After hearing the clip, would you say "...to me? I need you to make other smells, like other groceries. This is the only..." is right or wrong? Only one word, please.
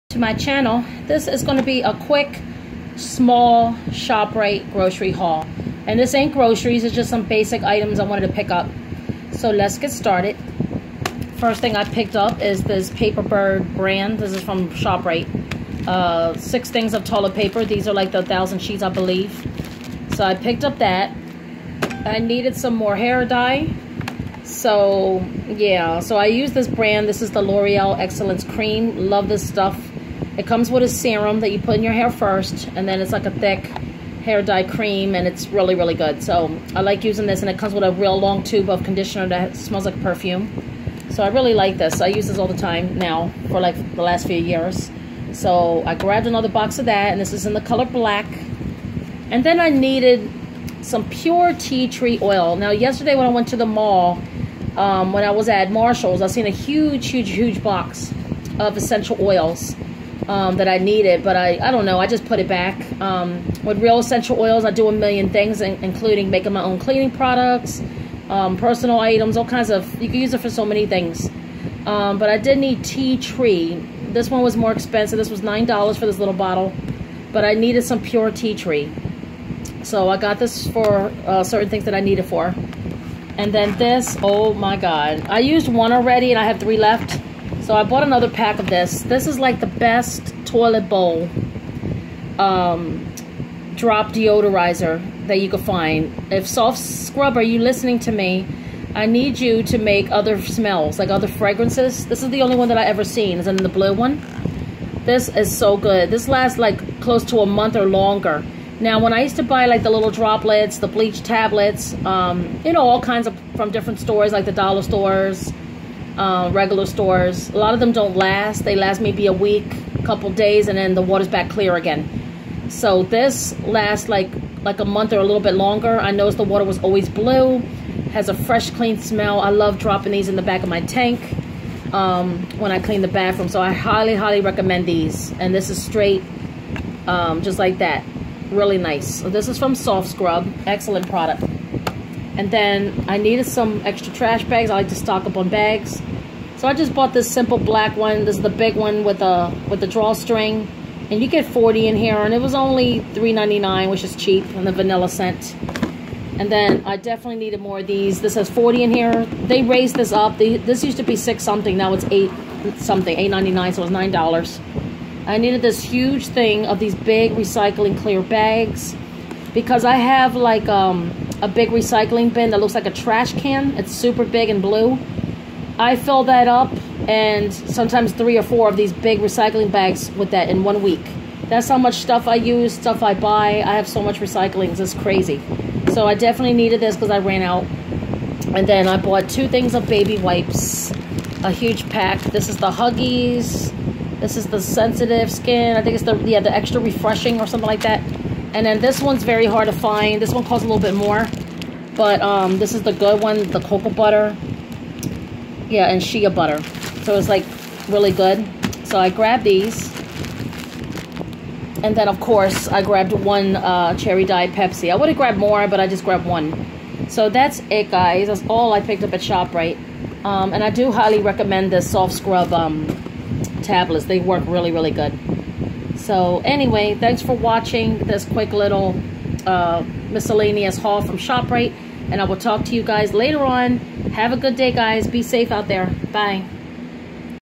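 wrong.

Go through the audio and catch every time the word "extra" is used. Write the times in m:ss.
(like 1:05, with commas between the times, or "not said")
2:23, 3:16.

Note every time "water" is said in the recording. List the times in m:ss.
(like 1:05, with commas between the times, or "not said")
2:01, 2:06.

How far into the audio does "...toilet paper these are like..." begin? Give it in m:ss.
0:17.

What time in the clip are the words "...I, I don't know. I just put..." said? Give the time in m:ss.
1:01.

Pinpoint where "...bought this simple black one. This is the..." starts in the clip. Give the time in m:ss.
2:26.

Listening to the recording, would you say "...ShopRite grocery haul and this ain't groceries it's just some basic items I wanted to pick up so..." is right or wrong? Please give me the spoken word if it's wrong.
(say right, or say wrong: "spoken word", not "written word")
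right.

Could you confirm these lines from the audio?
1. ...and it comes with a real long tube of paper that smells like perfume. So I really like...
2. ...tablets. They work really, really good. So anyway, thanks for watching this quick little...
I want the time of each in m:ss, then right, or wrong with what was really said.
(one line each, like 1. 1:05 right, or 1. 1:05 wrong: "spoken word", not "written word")
1. 0:37 wrong: "conditioner", not "paper"
2. 3:43 right.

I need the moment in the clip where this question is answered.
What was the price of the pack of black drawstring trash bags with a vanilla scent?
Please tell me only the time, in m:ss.
2:33.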